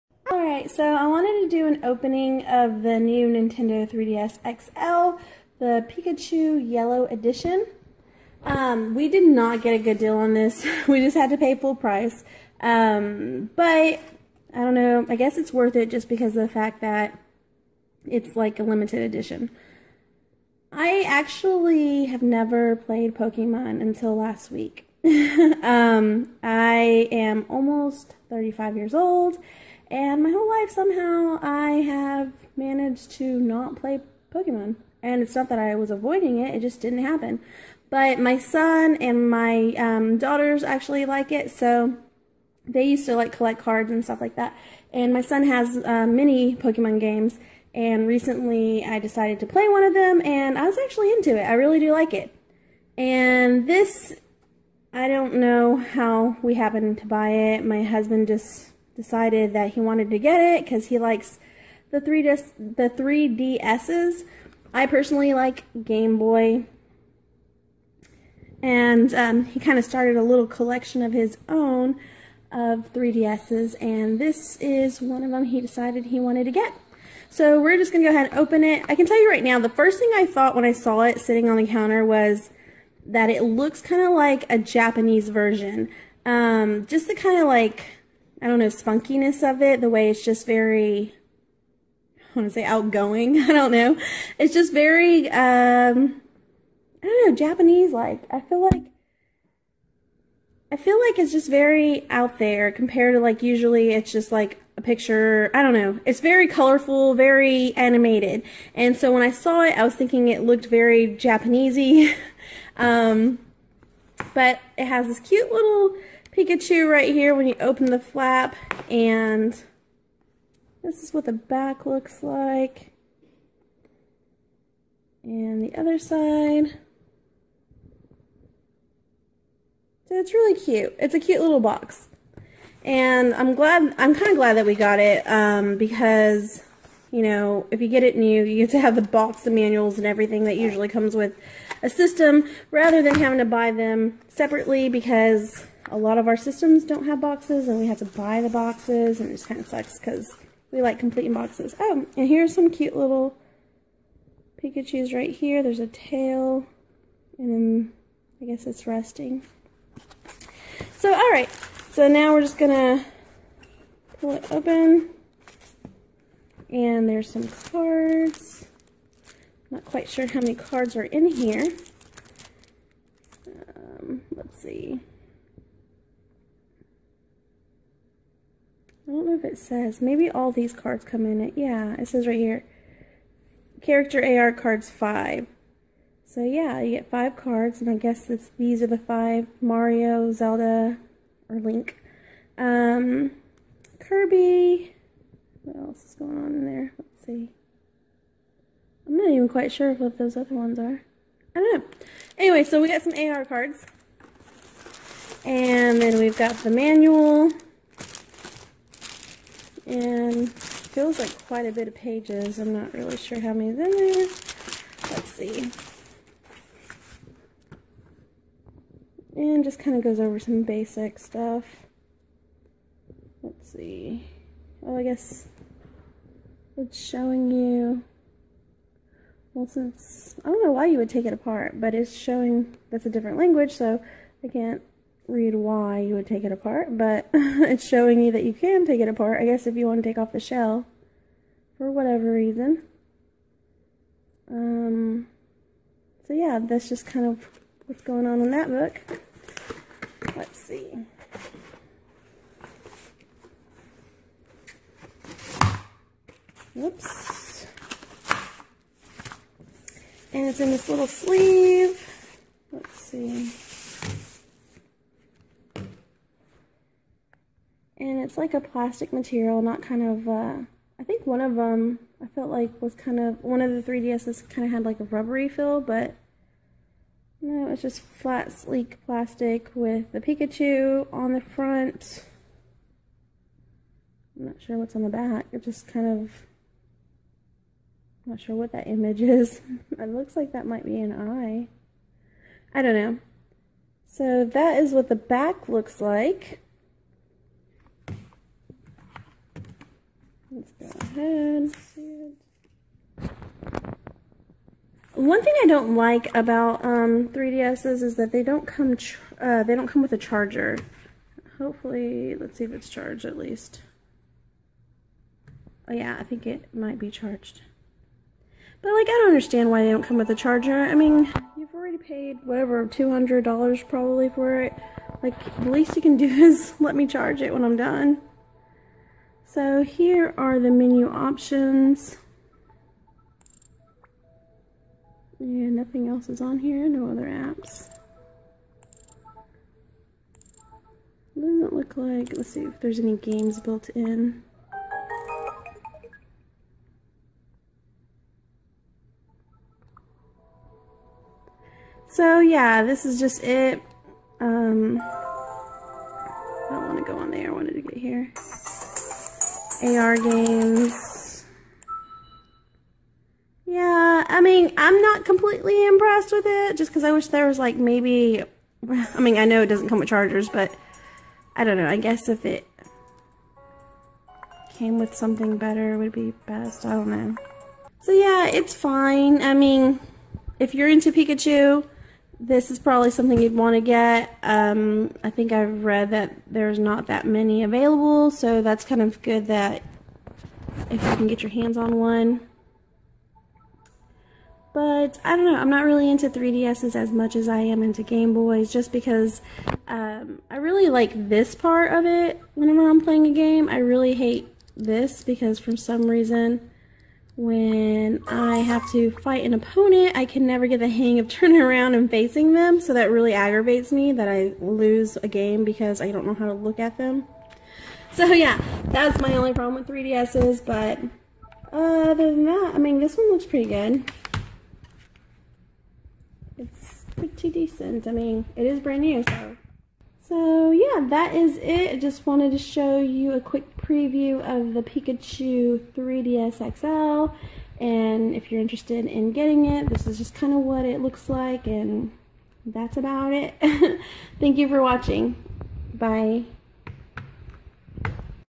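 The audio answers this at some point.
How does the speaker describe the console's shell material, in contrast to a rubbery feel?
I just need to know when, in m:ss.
4:38.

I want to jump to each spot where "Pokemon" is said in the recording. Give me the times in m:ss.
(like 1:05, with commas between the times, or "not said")
0:23, 0:34, 0:46.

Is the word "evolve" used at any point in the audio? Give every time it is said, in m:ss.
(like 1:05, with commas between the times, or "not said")
not said.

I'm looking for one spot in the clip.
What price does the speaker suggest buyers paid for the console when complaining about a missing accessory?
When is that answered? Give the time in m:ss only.
5:22.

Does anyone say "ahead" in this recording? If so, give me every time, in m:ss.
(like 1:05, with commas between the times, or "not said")
1:18, 5:01.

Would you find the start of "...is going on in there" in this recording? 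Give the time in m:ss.
3:16.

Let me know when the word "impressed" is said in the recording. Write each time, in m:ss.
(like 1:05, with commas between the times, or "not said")
6:05.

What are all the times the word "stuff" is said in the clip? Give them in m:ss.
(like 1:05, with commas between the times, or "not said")
0:44, 3:41.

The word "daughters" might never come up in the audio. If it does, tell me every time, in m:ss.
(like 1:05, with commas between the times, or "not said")
0:40.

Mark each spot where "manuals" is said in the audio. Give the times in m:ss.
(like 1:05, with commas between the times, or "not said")
2:19, 3:26.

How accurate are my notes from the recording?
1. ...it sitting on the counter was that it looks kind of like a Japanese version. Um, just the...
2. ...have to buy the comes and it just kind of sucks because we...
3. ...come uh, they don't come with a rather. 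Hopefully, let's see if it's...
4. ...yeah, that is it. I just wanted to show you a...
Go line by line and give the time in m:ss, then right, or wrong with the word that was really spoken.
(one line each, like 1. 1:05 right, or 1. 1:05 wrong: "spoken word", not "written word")
1. 1:21 right
2. 2:27 wrong: "boxes", not "comes"
3. 5:08 wrong: "charger", not "rather"
4. 7:10 right.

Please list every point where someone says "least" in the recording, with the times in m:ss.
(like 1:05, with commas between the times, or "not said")
5:13, 5:25.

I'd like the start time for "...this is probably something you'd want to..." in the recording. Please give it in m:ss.
6:22.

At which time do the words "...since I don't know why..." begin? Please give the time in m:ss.
3:49.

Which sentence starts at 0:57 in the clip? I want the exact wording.
My husband just decided that he wanted to get it because he likes the three the three DSs.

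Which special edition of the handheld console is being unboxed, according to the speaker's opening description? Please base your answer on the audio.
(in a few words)
Pikachu Yellow Edition.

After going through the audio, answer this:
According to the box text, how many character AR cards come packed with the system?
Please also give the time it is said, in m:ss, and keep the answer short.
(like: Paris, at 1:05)
5, at 3:04.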